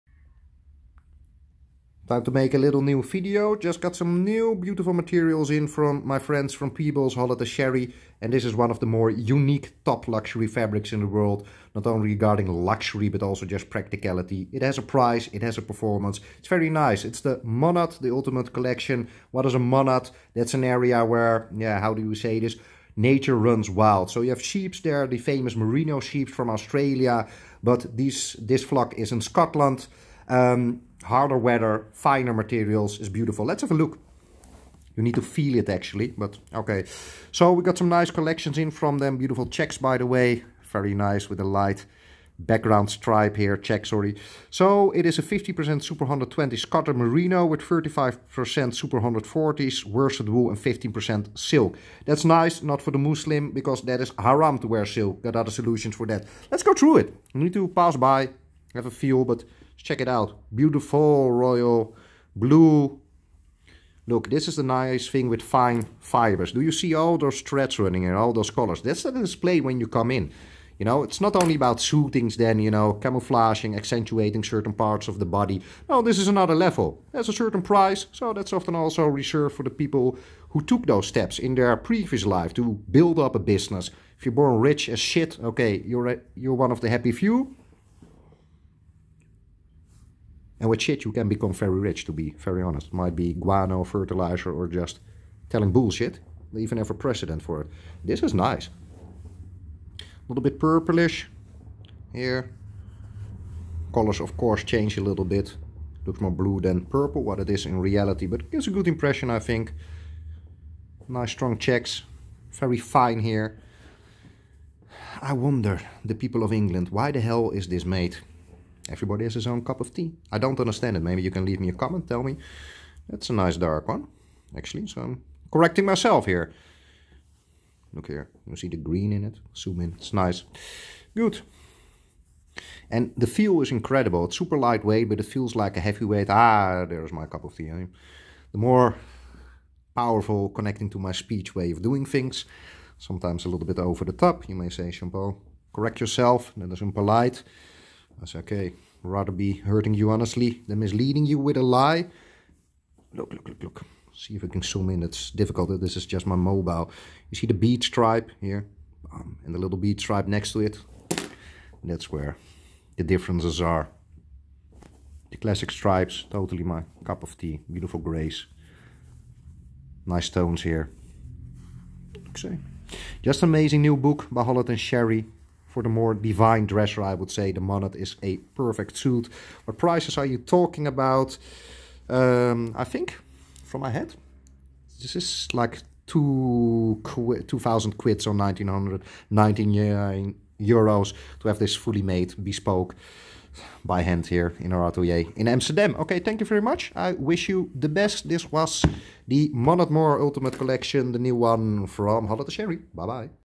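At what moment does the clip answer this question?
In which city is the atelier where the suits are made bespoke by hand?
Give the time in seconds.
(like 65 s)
195 s.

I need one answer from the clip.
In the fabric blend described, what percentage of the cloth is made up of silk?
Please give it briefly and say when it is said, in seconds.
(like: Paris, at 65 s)
15%, at 50 s.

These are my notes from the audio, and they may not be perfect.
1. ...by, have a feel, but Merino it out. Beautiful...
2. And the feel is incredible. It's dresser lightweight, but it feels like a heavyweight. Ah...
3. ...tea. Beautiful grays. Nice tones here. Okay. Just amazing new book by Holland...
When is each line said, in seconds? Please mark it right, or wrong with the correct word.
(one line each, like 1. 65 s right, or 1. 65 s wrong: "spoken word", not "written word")
1. 57 s wrong: "Check", not "Merino"
2. 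132 s wrong: "super", not "dresser"
3. 167 s right.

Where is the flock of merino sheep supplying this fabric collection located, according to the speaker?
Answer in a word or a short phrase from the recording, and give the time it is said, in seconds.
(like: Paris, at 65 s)
Scotland, at 29 s.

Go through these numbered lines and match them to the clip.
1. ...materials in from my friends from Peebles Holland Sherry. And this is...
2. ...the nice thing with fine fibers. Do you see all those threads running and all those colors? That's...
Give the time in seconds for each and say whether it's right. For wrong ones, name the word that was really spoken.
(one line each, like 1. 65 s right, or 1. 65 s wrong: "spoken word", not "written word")
1. 4 s right
2. 64 s right.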